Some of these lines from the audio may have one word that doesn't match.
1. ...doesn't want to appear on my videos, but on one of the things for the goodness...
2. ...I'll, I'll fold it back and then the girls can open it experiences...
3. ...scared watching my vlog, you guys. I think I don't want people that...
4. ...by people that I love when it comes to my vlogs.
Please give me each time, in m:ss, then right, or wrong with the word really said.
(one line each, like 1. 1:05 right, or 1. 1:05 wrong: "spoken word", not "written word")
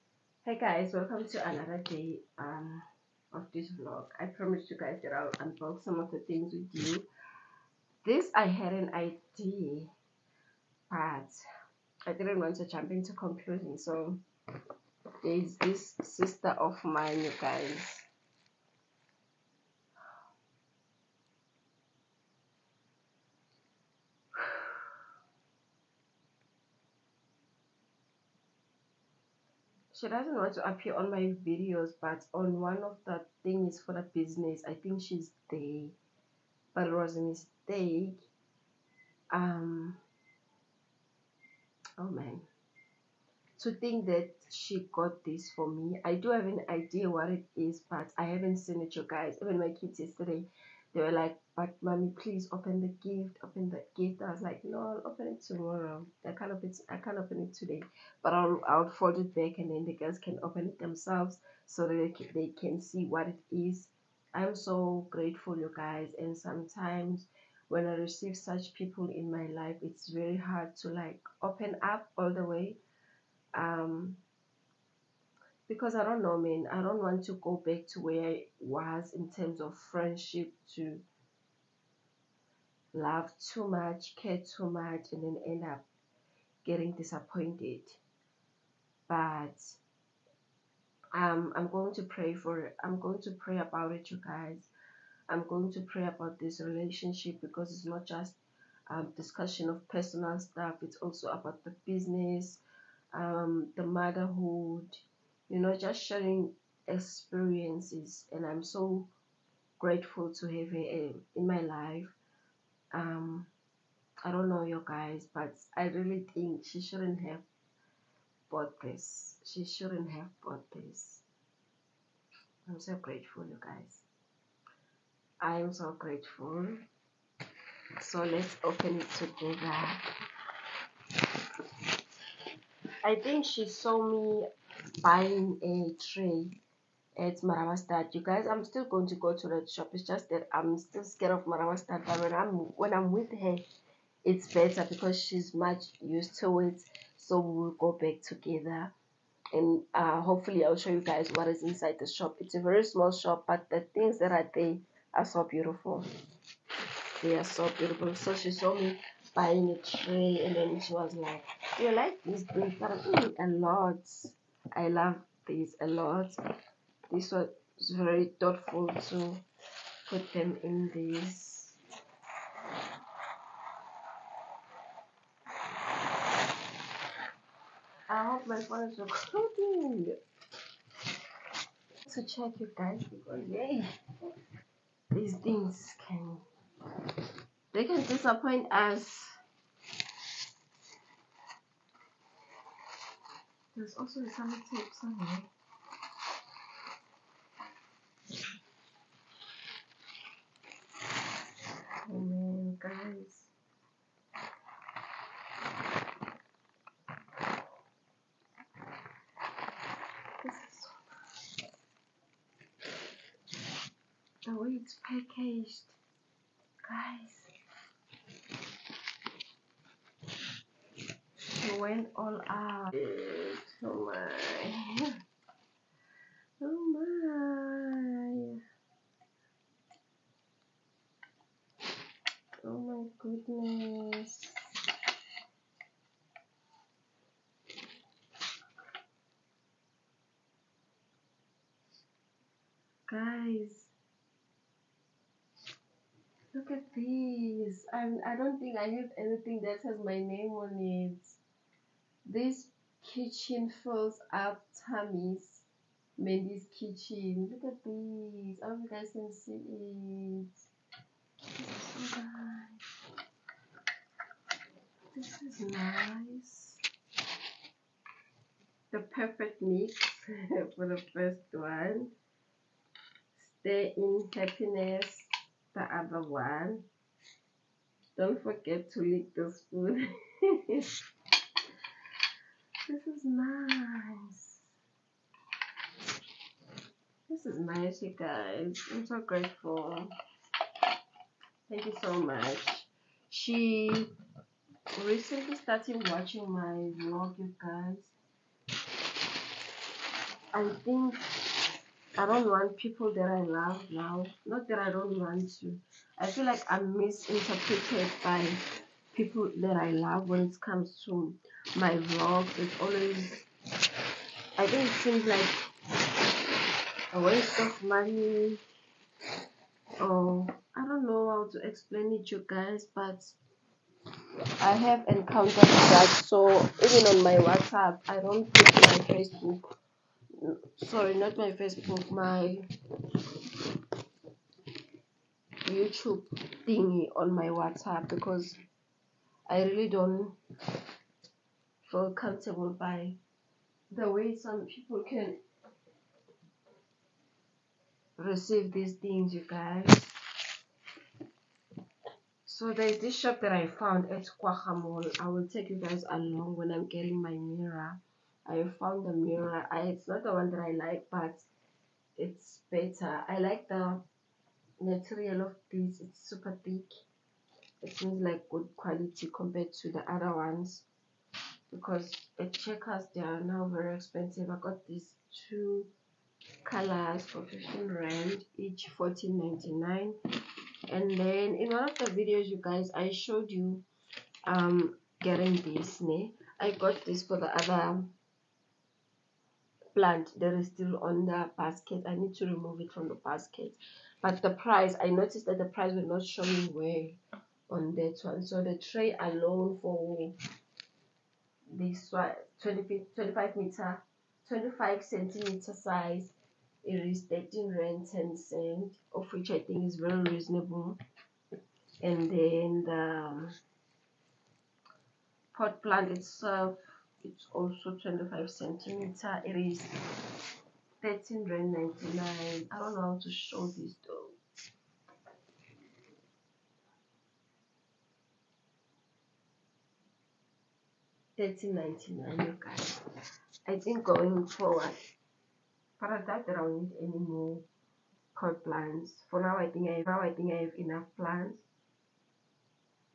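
1. 0:30 wrong: "business", not "goodness"
2. 0:58 wrong: "themselves", not "experiences"
3. 4:55 wrong: "started", not "scared"
4. 5:08 right.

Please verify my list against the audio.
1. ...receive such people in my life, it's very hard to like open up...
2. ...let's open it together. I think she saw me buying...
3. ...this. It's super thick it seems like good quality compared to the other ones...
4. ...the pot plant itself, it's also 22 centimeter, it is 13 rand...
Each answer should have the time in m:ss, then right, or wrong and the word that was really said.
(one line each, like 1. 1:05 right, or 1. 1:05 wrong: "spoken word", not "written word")
1. 1:07 right
2. 2:08 right
3. 6:05 right
4. 6:52 wrong: "25", not "22".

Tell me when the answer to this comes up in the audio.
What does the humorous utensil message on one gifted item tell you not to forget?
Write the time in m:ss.
4:38.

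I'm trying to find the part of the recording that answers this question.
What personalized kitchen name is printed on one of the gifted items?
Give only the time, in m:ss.
4:16.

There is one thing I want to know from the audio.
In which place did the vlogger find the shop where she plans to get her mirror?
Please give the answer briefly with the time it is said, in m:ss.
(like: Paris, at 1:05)
Kwaha, at 5:54.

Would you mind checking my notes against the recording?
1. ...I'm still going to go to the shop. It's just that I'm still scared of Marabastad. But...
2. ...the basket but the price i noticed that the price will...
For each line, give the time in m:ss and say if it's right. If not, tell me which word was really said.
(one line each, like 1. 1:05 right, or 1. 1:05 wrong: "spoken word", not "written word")
1. 2:18 right
2. 6:33 right.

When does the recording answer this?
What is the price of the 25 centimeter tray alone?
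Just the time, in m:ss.
6:47.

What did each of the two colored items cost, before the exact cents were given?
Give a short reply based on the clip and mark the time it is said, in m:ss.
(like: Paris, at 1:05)
15 rand, at 6:17.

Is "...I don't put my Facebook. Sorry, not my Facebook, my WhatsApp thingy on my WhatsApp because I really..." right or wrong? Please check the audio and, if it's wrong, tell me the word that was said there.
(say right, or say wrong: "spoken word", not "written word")
wrong: "YouTube", not "WhatsApp".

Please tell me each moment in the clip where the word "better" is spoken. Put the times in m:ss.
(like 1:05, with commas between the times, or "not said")
2:24, 6:02.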